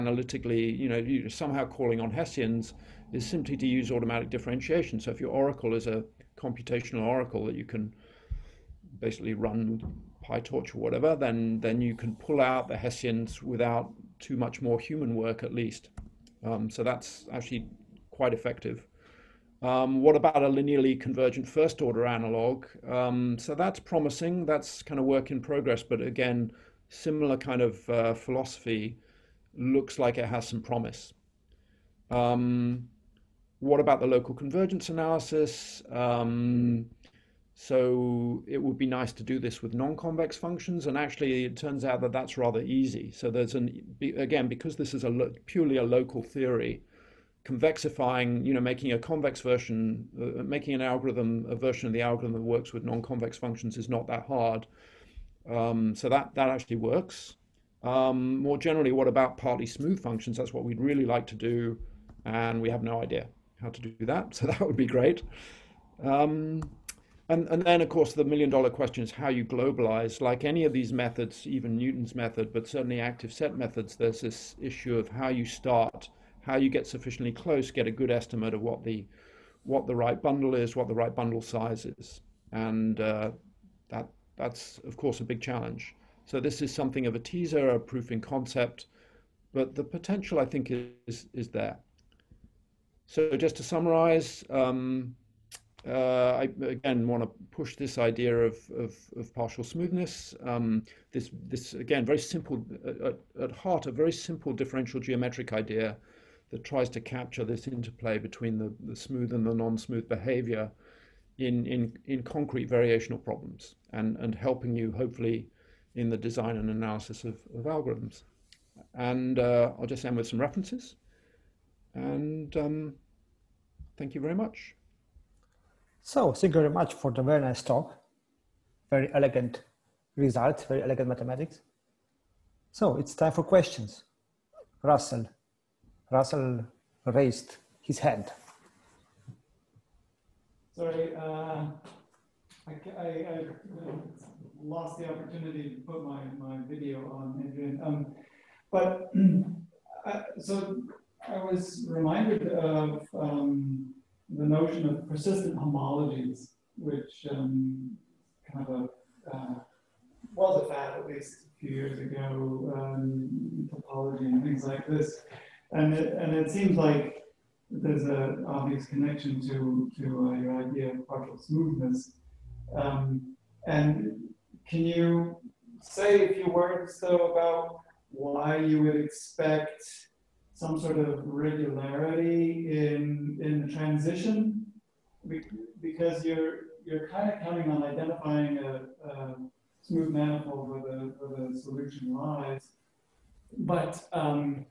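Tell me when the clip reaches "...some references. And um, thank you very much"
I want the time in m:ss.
2:00.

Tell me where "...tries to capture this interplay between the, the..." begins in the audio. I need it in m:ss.
1:46.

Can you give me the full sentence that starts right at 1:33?
So just to summarize, um, uh, I again want to push this idea of, of, of partial smoothness.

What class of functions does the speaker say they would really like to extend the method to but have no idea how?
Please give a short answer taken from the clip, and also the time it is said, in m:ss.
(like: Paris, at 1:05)
Partly smooth functions, at 0:59.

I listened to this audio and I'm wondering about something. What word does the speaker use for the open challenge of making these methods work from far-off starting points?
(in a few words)
Globalize.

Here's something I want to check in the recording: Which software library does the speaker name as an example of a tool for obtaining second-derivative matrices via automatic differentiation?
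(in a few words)
PyTorch.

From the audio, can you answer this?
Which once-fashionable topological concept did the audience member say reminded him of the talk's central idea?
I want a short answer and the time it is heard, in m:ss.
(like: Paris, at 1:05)
Persistent homologies, at 2:35.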